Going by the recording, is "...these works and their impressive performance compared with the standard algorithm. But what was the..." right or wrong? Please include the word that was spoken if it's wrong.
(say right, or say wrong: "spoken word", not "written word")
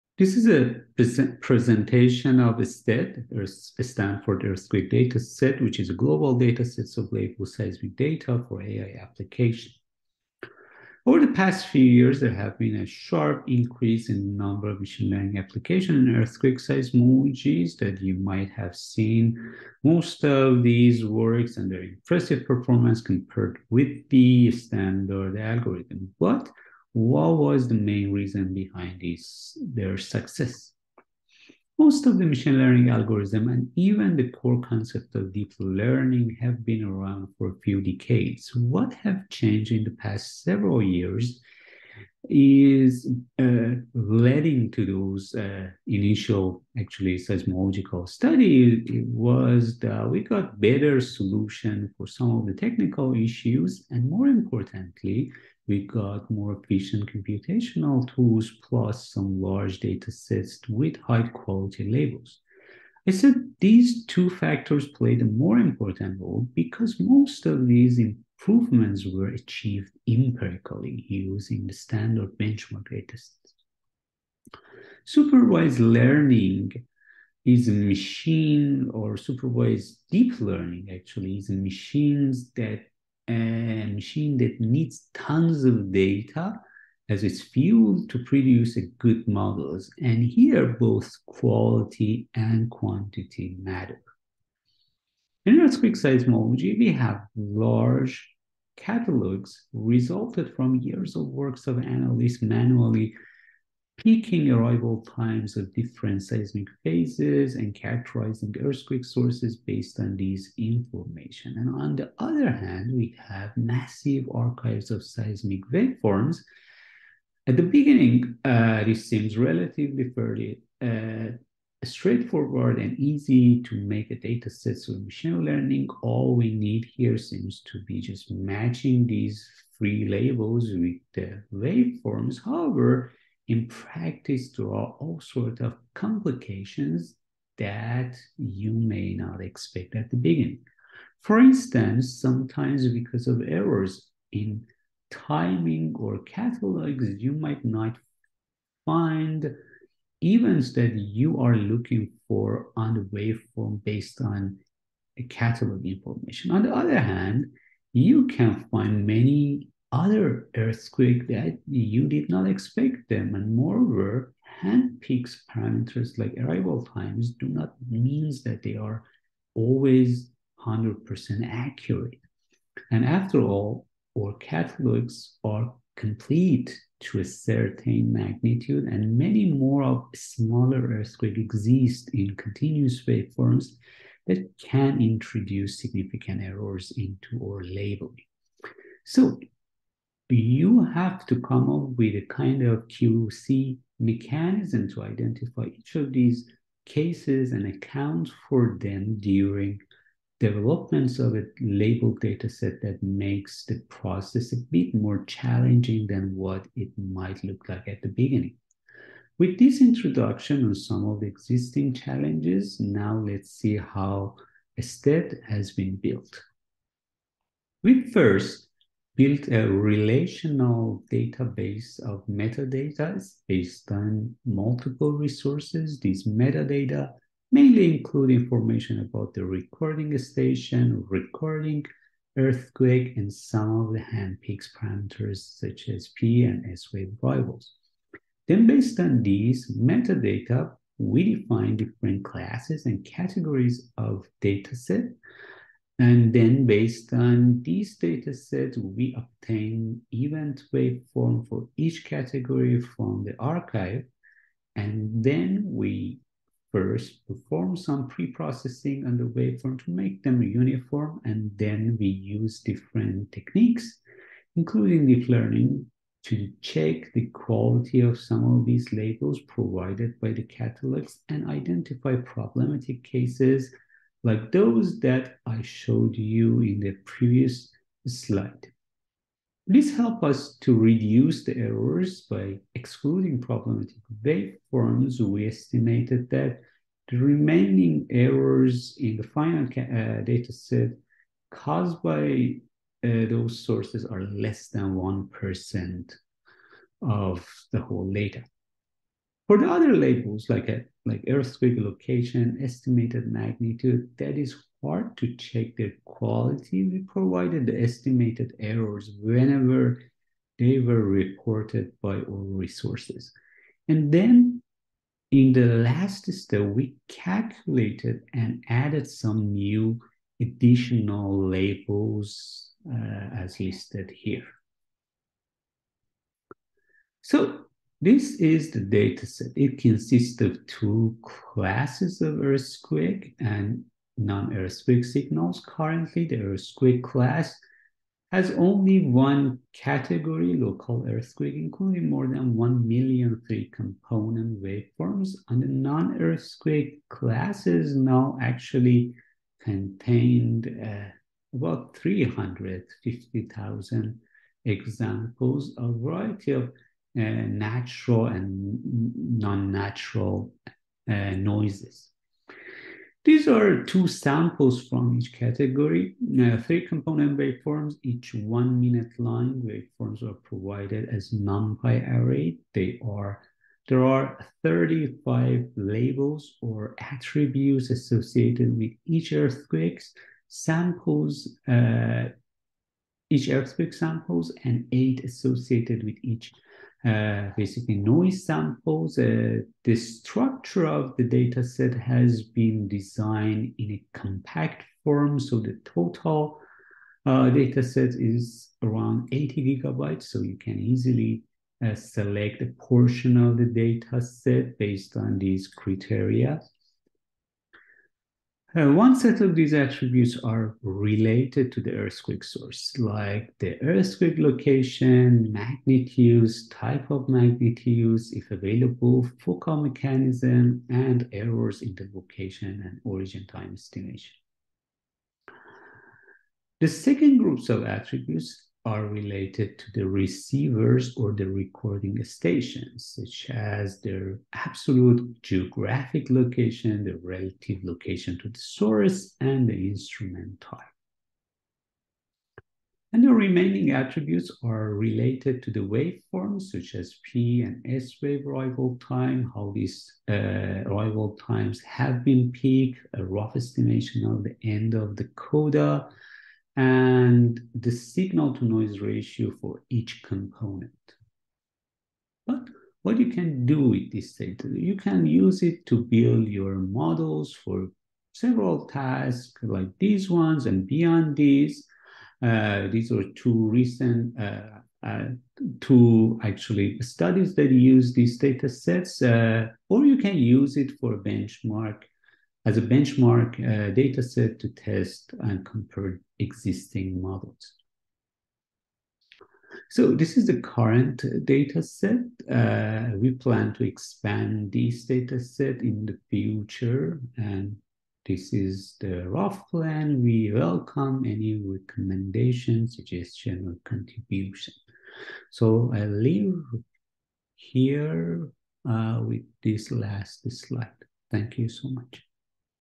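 right.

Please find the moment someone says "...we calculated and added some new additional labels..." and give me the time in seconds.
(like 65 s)
316 s.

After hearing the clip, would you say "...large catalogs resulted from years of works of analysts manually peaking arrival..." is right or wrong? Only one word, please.
right.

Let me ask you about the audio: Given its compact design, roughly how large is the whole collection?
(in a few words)
80 gigabytes.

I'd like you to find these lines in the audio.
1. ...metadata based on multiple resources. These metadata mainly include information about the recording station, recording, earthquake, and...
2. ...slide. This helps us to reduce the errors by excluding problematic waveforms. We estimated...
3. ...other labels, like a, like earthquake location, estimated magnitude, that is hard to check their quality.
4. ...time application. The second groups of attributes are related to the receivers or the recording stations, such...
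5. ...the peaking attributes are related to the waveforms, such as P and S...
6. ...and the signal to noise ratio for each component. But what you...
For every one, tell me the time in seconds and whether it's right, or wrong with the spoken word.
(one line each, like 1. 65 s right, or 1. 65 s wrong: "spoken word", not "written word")
1. 222 s right
2. 278 s right
3. 299 s right
4. 423 s wrong: "estimation", not "application"
5. 443 s wrong: "remaining", not "peaking"
6. 456 s right.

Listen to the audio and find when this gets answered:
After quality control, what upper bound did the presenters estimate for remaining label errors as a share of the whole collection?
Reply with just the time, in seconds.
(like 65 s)
294 s.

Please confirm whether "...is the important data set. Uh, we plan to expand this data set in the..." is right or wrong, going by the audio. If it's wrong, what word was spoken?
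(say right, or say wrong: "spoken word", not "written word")
wrong: "current", not "important".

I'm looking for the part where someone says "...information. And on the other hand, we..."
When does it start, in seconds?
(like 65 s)
110 s.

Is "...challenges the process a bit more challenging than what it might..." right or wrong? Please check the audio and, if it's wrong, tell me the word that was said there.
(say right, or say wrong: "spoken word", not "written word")
wrong: "makes", not "challenges".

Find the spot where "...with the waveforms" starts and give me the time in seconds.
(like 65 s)
130 s.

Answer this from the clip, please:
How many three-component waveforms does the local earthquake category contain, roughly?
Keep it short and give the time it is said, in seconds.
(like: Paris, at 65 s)
more than 1 million, at 342 s.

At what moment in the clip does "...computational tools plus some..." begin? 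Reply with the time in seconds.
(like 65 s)
57 s.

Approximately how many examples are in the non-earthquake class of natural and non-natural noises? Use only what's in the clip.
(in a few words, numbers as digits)
350,000.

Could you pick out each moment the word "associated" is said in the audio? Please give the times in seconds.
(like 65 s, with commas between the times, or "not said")
377 s, 385 s.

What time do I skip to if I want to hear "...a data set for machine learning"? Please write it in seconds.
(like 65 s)
124 s.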